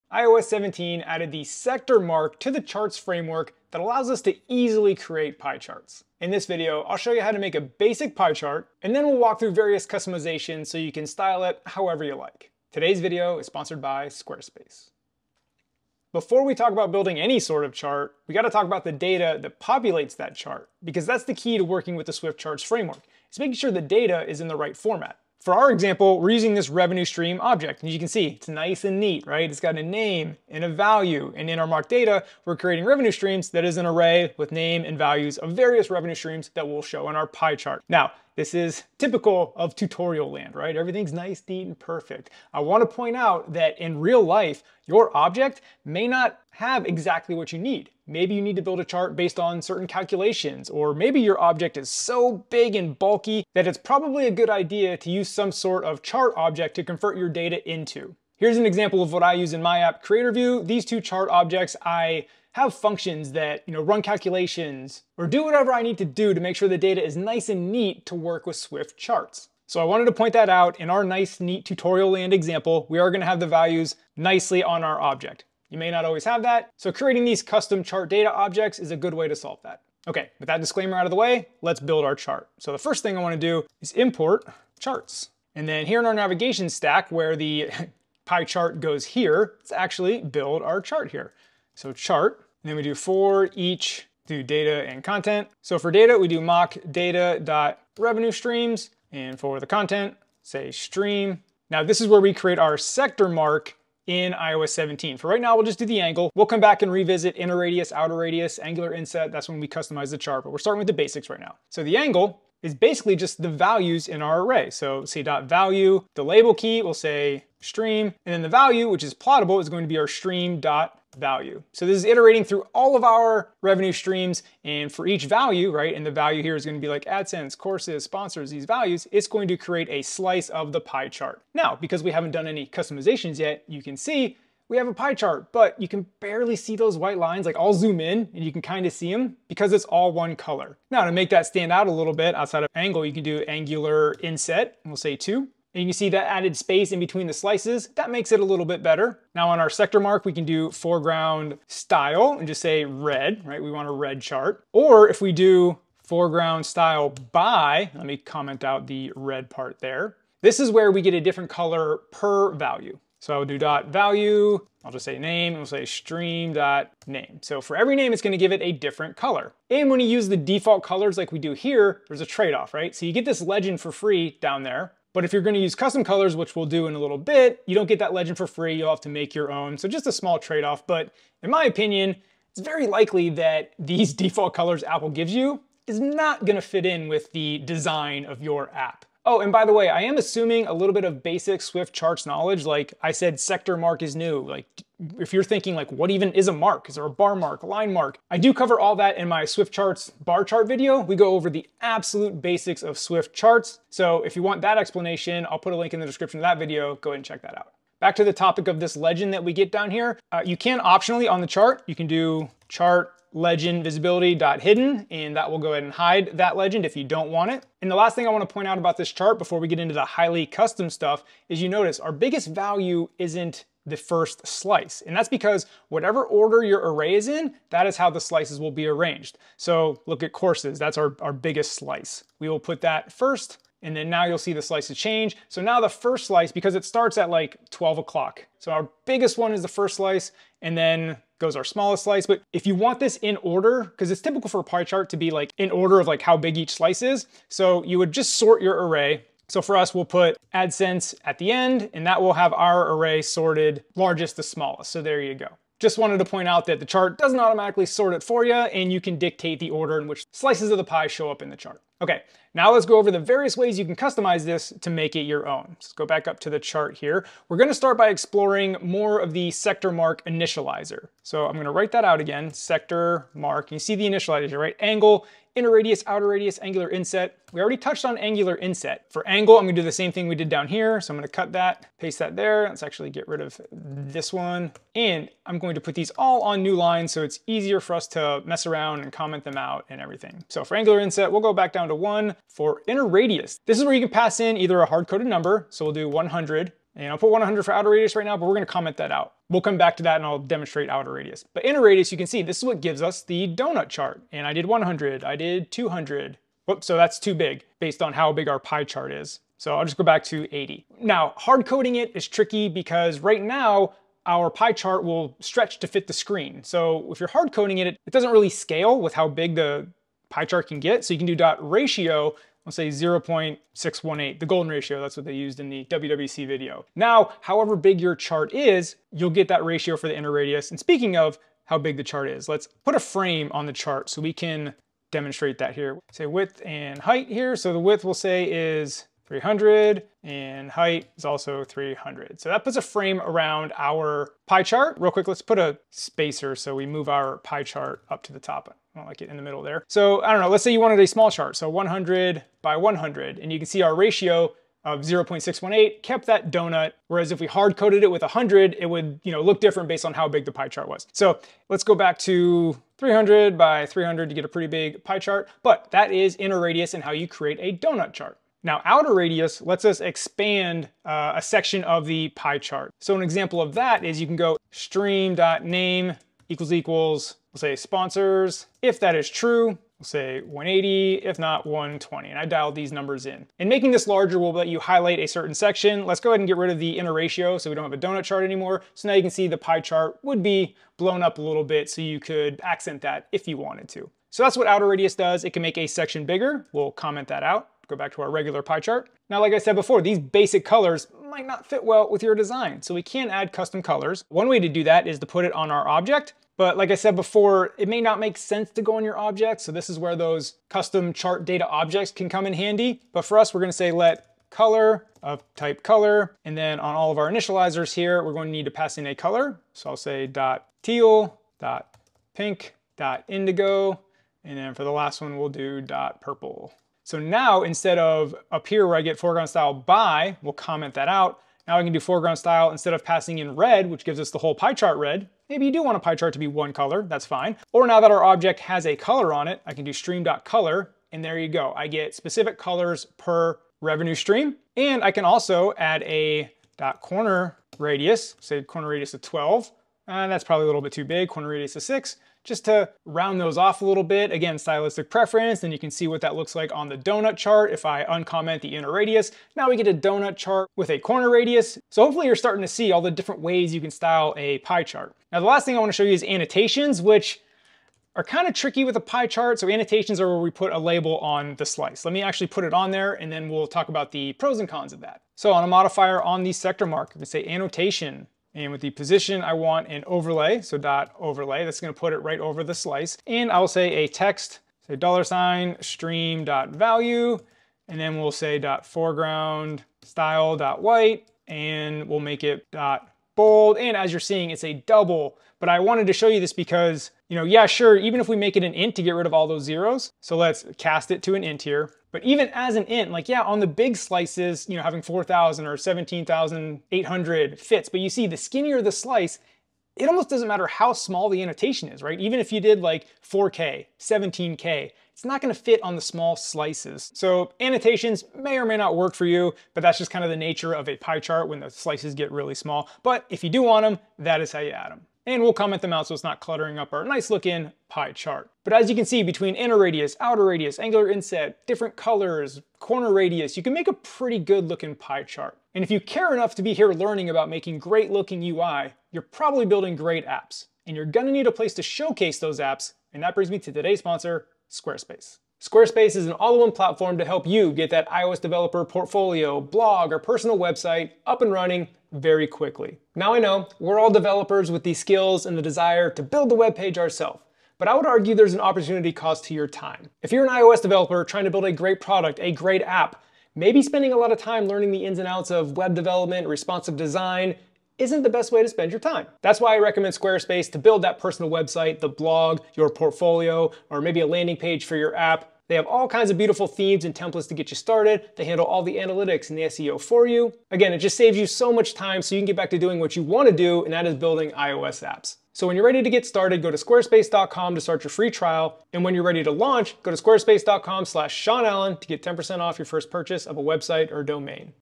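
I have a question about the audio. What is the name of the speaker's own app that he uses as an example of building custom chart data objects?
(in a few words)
CreatorView.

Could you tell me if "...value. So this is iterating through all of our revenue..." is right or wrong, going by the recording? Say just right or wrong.
right.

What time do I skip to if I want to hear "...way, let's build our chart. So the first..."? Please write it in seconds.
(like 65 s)
81 s.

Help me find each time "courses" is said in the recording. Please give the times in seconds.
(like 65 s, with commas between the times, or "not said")
127 s, 230 s.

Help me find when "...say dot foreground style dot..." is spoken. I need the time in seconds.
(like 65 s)
488 s.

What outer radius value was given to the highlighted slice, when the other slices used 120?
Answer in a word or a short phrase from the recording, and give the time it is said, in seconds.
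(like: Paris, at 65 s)
180, at 380 s.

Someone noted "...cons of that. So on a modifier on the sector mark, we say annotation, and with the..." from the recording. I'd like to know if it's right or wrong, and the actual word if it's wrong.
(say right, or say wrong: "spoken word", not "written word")
right.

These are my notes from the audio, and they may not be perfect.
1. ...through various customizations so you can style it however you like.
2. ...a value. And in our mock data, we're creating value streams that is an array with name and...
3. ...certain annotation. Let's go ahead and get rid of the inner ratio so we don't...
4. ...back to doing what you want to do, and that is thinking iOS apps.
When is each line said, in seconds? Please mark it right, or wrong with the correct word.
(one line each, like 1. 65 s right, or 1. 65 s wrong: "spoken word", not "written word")
1. 9 s right
2. 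30 s wrong: "revenue", not "value"
3. 385 s wrong: "section", not "annotation"
4. 582 s wrong: "building", not "thinking".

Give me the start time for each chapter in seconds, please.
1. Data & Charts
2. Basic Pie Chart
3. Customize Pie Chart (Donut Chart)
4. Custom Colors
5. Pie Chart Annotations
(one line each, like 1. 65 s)
1. 18 s
2. 81 s
3. 261 s
4. 399 s
5. 465 s.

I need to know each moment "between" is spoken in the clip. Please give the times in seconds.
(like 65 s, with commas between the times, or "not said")
146 s, 529 s.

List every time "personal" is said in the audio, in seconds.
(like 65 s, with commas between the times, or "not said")
550 s, 571 s.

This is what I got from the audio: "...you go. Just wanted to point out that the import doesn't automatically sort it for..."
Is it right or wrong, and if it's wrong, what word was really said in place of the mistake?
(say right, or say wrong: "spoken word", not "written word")
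wrong: "chart", not "import".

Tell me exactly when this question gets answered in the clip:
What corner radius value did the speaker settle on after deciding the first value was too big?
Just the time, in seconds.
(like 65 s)
451 s.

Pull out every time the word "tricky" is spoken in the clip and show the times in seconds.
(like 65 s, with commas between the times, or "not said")
312 s, 468 s.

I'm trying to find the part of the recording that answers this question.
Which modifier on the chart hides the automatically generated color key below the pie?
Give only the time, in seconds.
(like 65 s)
212 s.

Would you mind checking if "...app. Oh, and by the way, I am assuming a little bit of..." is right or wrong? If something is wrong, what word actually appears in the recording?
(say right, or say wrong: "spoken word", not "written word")
right.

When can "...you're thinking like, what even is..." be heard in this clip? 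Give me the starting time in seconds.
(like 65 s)
195 s.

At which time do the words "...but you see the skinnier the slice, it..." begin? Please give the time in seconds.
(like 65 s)
507 s.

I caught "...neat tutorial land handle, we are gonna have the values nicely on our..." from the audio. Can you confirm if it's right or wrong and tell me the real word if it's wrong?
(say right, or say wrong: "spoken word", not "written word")
wrong: "example", not "handle".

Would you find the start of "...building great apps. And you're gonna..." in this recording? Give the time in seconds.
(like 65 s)
539 s.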